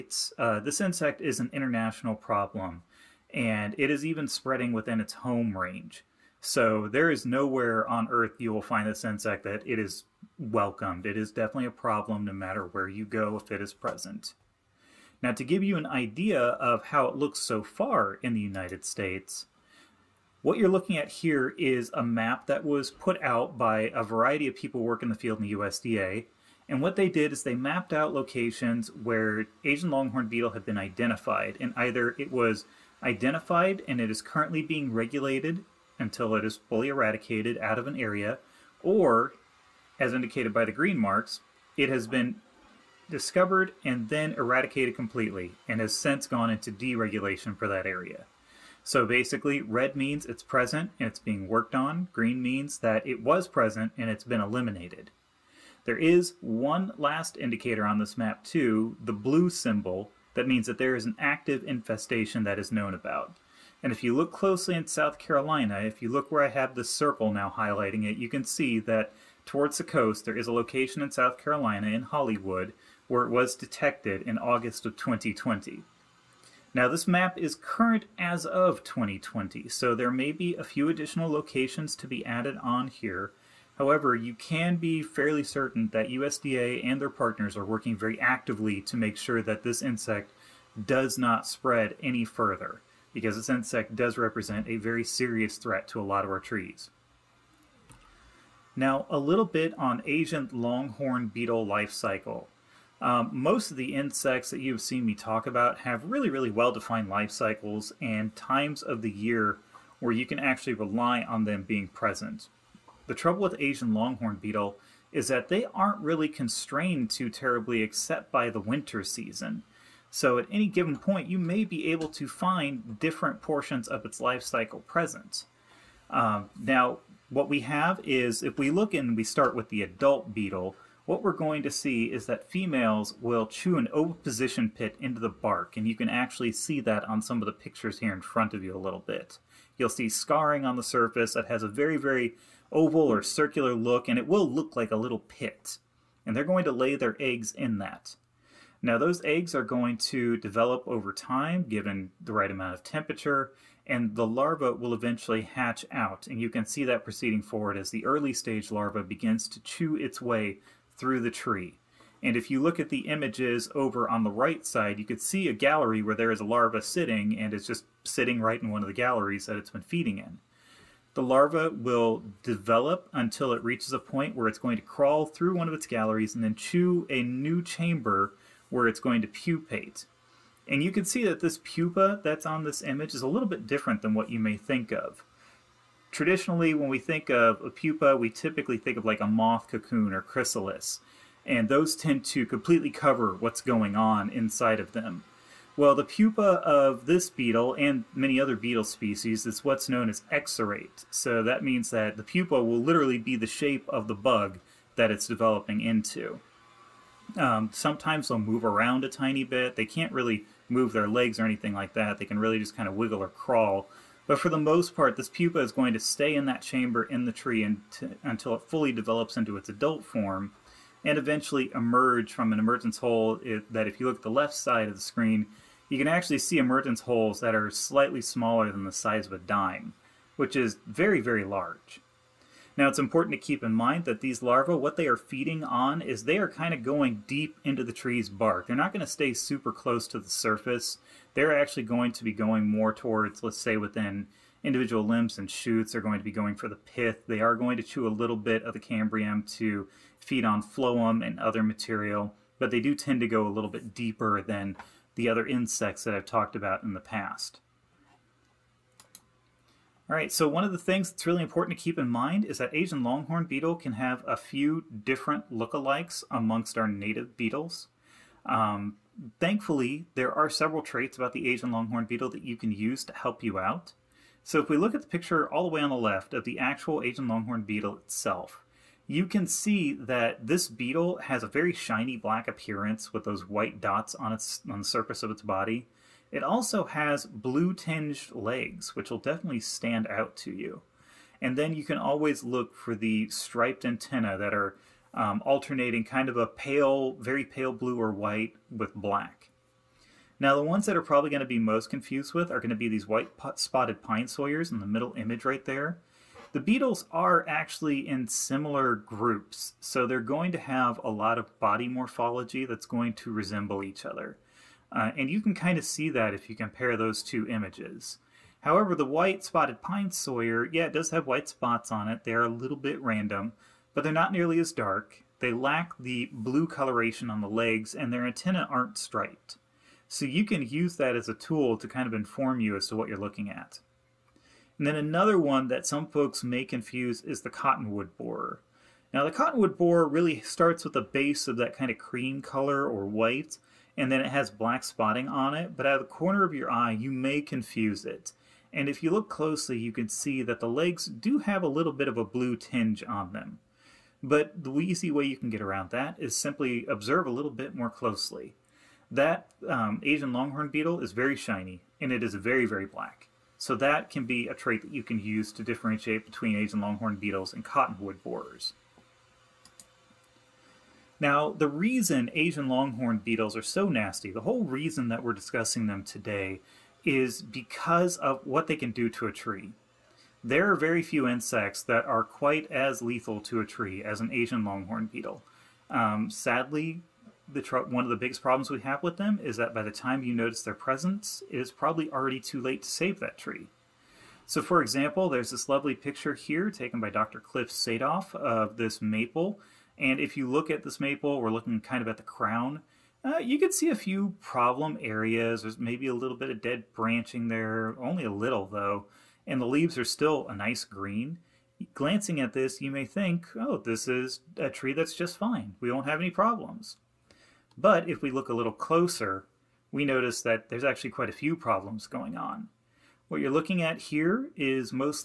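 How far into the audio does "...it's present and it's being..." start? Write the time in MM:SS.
00:50.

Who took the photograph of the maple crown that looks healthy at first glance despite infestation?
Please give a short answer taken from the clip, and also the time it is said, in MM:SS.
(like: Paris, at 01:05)
Dr. Cliff Sadof, at 06:37.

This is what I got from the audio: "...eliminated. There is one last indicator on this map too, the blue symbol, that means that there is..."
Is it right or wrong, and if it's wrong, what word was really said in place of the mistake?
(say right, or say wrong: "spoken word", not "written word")
right.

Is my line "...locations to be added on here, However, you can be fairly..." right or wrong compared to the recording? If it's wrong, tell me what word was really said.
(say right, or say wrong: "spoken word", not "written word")
right.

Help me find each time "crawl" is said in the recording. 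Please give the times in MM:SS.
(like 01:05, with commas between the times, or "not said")
02:54, 03:33.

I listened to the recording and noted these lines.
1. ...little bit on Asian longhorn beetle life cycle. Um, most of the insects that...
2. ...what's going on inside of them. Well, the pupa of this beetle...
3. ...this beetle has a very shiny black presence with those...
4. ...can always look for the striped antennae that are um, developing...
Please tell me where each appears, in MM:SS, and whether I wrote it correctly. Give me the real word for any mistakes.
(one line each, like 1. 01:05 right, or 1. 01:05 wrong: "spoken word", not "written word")
1. 01:39 right
2. 03:13 right
3. 04:40 wrong: "appearance", not "presence"
4. 04:51 wrong: "alternating", not "developing".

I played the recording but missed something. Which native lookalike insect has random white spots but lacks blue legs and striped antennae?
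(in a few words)
White spotted pine sawyer.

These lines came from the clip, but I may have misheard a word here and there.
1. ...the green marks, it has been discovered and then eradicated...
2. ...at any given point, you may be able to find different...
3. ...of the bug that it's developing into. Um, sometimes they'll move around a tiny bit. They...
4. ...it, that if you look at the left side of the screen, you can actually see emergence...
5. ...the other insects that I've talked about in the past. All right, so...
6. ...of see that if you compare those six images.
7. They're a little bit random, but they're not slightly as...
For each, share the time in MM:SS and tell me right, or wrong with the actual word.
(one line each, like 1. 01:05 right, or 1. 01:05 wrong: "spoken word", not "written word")
1. 00:40 right
2. 02:00 right
3. 03:23 right
4. 03:43 right
5. 04:15 right
6. 05:15 wrong: "two", not "six"
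7. 05:22 wrong: "nearly", not "slightly".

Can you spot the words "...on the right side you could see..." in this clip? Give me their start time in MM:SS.
02:44.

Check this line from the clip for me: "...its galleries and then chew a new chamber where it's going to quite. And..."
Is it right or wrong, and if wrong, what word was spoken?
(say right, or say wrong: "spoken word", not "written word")
wrong: "pupate", not "quite".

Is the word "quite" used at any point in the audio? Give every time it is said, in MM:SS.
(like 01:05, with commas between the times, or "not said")
06:22, 07:01.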